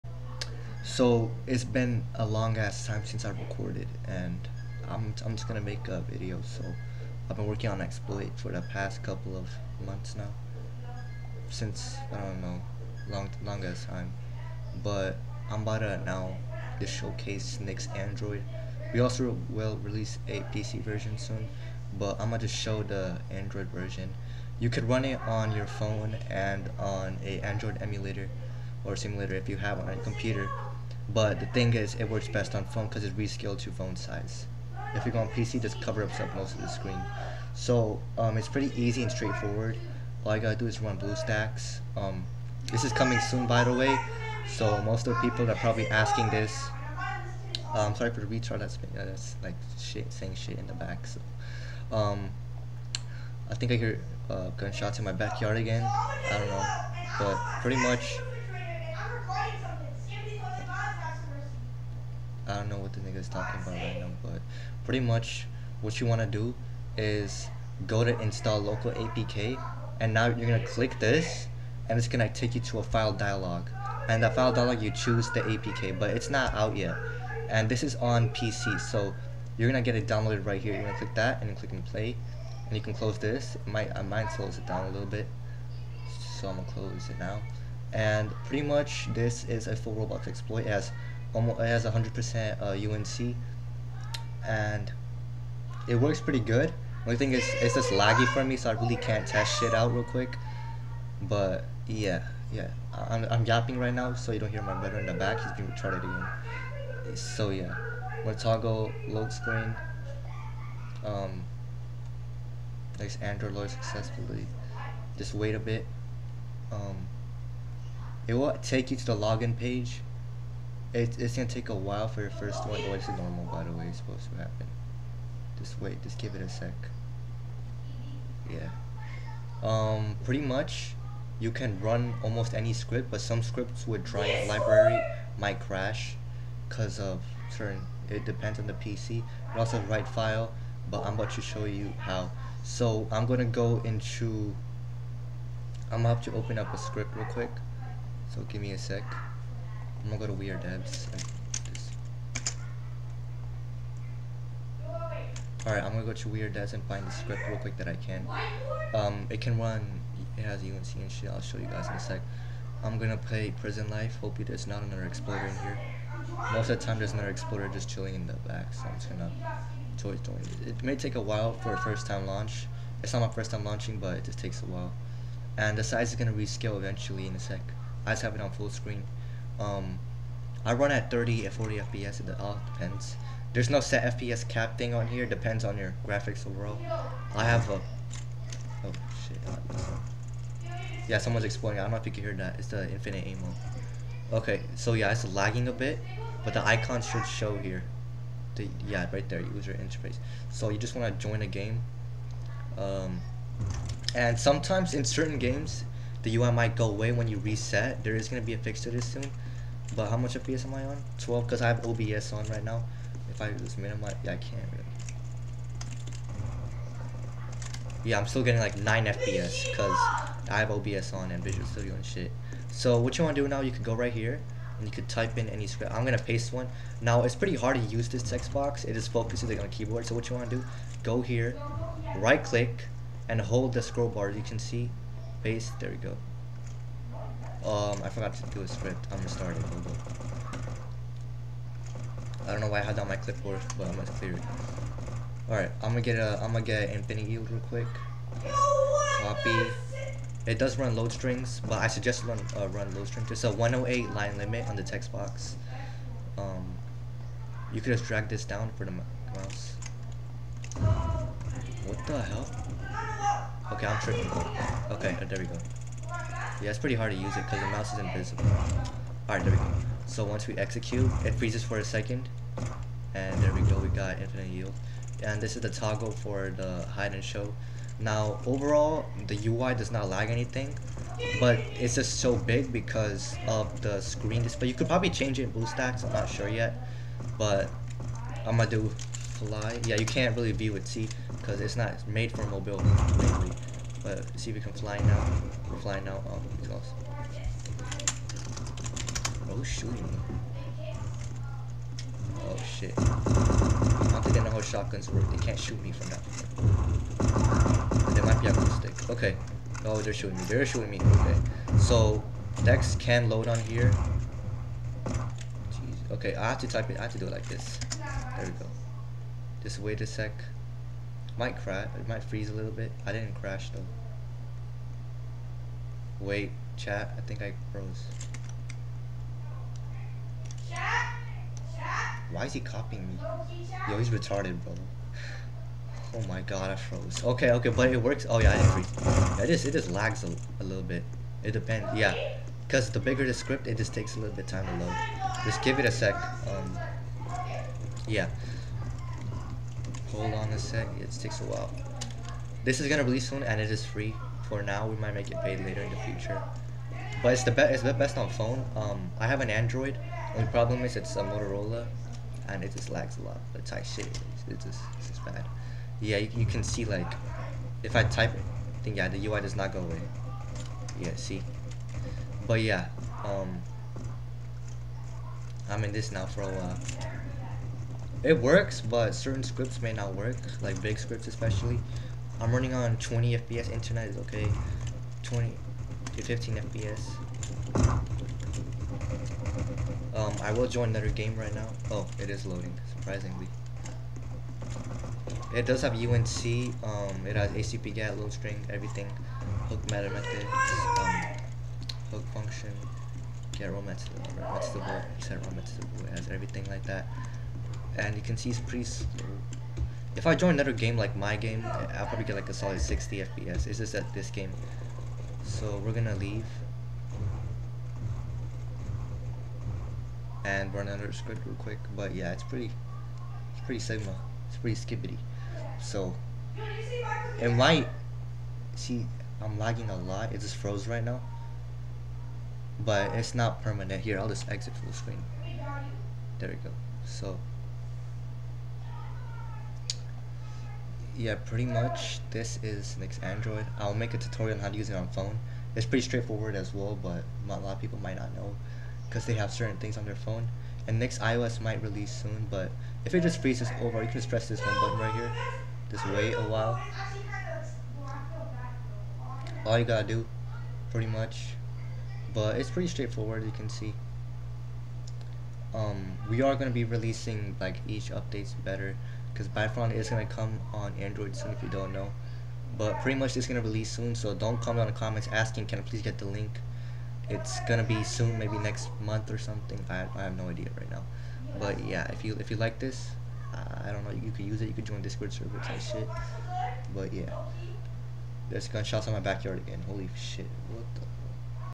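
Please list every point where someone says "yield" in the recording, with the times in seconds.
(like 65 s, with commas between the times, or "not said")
247 s, 274 s.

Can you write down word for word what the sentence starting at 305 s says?
They can't shoot me from that.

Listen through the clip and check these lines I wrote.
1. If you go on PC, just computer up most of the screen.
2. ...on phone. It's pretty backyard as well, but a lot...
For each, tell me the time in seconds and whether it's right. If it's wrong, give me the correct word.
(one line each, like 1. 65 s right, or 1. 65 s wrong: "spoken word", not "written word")
1. 34 s wrong: "cover", not "computer"
2. 444 s wrong: "straightforward", not "backyard".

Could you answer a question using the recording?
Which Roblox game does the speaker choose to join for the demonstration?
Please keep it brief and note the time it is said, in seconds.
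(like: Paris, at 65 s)
Prison Life, at 163 s.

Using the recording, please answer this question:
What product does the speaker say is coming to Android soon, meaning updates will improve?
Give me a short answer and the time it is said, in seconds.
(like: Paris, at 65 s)
Battlefront, at 469 s.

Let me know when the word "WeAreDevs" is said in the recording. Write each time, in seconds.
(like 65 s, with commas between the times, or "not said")
150 s, 156 s.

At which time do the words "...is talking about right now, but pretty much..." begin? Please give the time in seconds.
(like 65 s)
63 s.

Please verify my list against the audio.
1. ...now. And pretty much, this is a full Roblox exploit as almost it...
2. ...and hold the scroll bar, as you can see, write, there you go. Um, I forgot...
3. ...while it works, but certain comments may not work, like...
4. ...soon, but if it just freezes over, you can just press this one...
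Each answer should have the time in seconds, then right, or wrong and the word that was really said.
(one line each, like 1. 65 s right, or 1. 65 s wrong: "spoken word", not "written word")
1. 87 s right
2. 233 s wrong: "paste", not "write"
3. 376 s wrong: "scripts", not "comments"
4. 452 s right.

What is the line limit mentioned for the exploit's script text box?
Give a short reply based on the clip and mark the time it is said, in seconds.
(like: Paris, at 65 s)
108, at 253 s.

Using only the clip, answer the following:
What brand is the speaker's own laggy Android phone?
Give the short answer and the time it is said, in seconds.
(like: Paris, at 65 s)
Motorola, at 361 s.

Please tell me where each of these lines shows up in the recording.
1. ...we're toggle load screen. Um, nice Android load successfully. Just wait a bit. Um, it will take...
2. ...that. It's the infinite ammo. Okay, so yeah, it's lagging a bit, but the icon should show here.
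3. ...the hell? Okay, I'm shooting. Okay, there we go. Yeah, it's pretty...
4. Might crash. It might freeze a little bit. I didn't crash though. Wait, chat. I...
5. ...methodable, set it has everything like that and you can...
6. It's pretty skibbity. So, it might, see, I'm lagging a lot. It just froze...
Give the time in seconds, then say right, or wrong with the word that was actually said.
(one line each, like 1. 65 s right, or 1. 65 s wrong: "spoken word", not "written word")
1. 108 s right
2. 192 s right
3. 262 s wrong: "tripping", not "shooting"
4. 321 s right
5. 403 s right
6. 424 s right.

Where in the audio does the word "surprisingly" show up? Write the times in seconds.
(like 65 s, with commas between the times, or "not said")
392 s.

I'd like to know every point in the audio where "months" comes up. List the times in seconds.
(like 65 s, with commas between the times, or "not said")
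9 s, 479 s.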